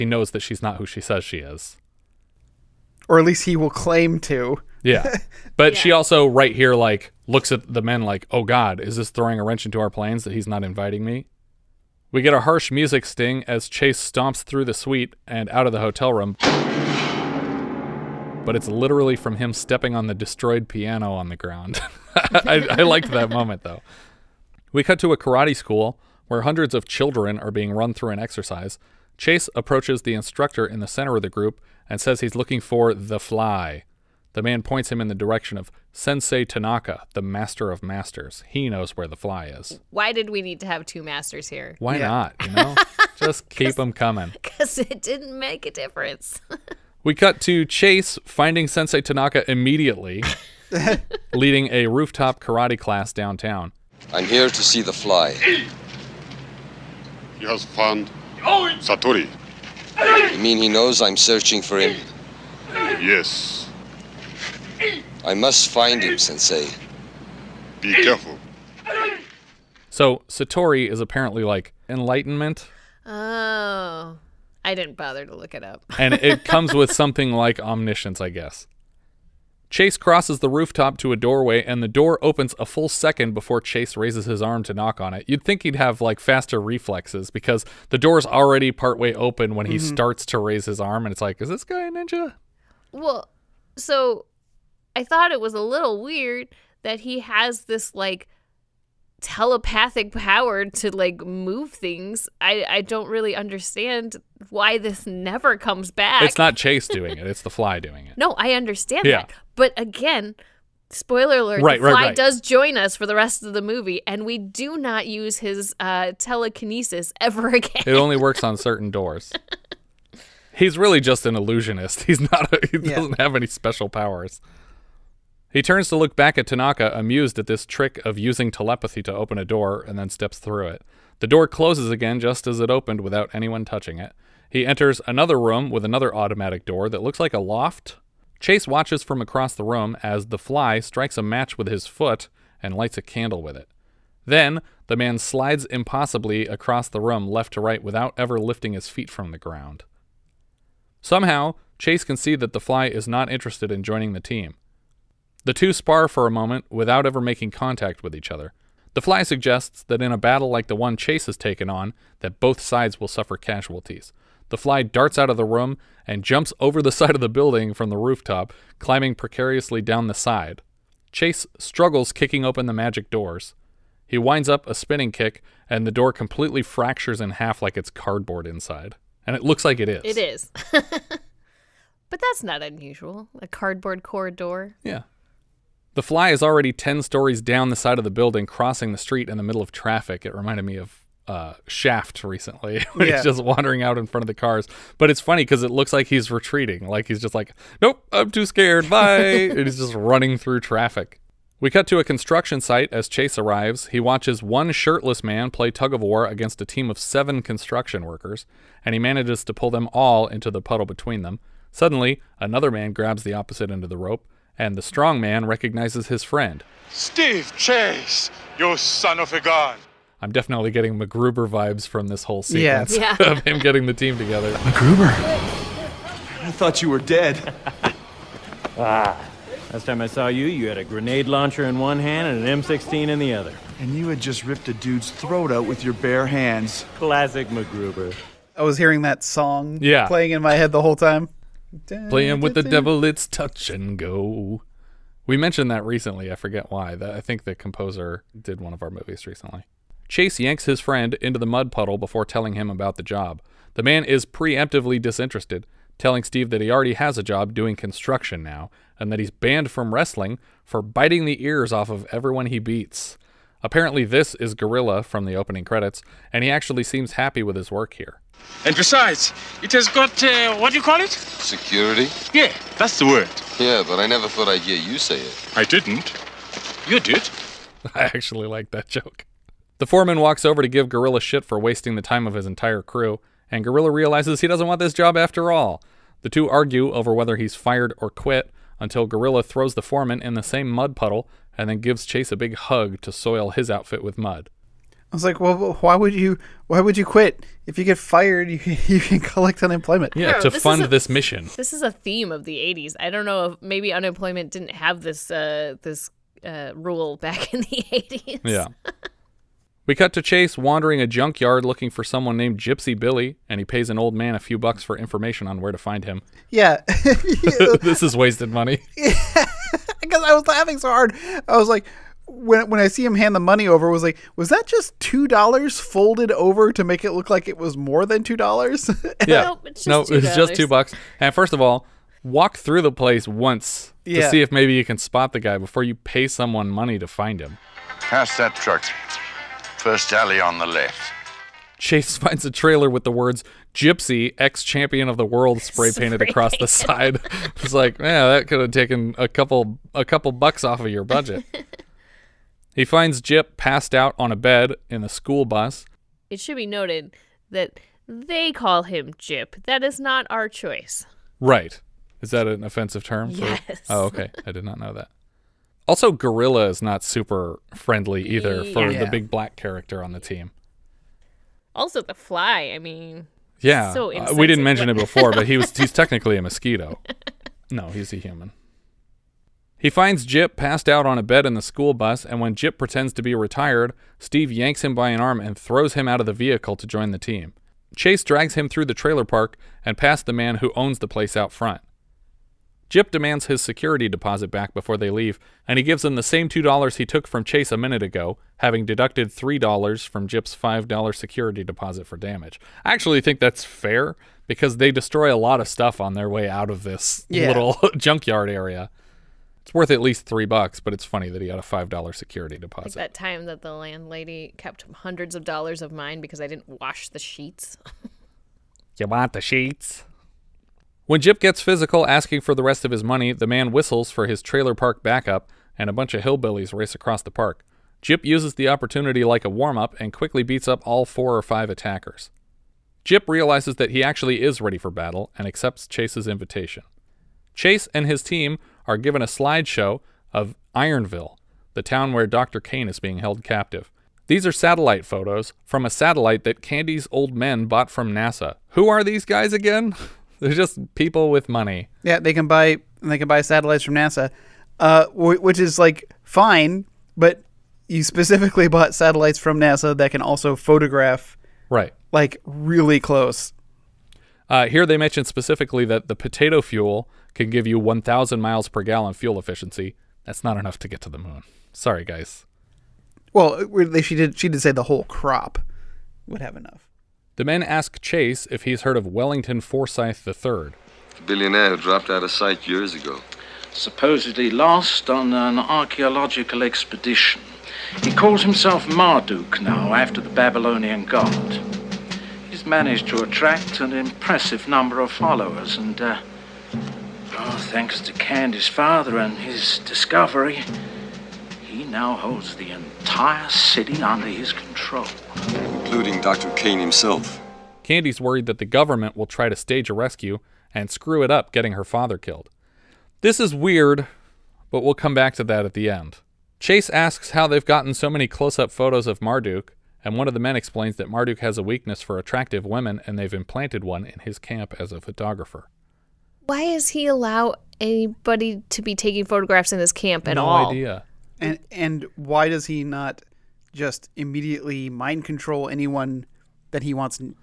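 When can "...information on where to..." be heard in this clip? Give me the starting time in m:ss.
5:14.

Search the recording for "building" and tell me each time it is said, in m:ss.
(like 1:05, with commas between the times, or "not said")
2:47, 3:08.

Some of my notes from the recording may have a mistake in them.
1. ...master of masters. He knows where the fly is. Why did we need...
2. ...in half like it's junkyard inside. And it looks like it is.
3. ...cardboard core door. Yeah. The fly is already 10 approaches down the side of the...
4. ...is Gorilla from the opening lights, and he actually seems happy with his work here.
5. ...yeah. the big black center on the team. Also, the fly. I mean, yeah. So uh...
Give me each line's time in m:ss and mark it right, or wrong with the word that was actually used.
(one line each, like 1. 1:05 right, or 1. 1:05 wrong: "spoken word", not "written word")
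1. 0:37 right
2. 2:57 wrong: "cardboard", not "junkyard"
3. 3:03 wrong: "stories", not "approaches"
4. 4:24 wrong: "credits", not "lights"
5. 6:08 wrong: "character", not "center".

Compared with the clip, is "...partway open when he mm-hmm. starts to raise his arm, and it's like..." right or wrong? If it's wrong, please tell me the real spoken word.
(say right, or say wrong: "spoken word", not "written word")
right.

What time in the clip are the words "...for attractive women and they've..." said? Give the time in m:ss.
8:41.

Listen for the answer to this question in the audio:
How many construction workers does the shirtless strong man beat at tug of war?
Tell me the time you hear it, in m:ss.
3:26.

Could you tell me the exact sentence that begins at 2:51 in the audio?
Chase struggles kicking open the magic doors.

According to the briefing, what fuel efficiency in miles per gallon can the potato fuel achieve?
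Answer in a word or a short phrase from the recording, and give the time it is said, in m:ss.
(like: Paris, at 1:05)
1000, at 7:47.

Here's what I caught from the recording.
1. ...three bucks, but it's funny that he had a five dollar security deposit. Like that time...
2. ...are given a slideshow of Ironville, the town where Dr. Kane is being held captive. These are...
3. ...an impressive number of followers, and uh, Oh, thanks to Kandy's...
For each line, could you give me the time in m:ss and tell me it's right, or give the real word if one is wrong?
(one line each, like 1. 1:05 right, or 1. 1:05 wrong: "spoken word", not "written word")
1. 6:50 right
2. 7:18 right
3. 8:13 right.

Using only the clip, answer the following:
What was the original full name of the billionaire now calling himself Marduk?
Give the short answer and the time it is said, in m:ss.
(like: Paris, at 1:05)
Wellington Forsyth III, at 7:59.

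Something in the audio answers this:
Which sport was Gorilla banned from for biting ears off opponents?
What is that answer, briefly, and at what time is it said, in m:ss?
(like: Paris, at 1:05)
wrestling, at 4:19.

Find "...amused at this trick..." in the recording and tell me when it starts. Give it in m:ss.
2:06.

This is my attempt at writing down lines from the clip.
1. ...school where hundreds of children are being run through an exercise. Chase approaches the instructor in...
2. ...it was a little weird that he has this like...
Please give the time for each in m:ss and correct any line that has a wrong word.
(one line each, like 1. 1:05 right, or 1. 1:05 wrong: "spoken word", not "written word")
1. 0:25 right
2. 1:35 right.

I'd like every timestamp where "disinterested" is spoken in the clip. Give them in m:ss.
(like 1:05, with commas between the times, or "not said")
4:14.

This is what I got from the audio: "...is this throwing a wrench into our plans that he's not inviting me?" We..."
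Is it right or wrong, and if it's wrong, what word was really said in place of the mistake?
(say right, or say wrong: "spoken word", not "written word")
right.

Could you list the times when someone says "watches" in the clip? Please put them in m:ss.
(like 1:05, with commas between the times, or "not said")
2:18, 3:23.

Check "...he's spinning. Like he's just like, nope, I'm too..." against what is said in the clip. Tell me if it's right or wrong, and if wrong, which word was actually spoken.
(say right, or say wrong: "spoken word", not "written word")
wrong: "retreating", not "spinning".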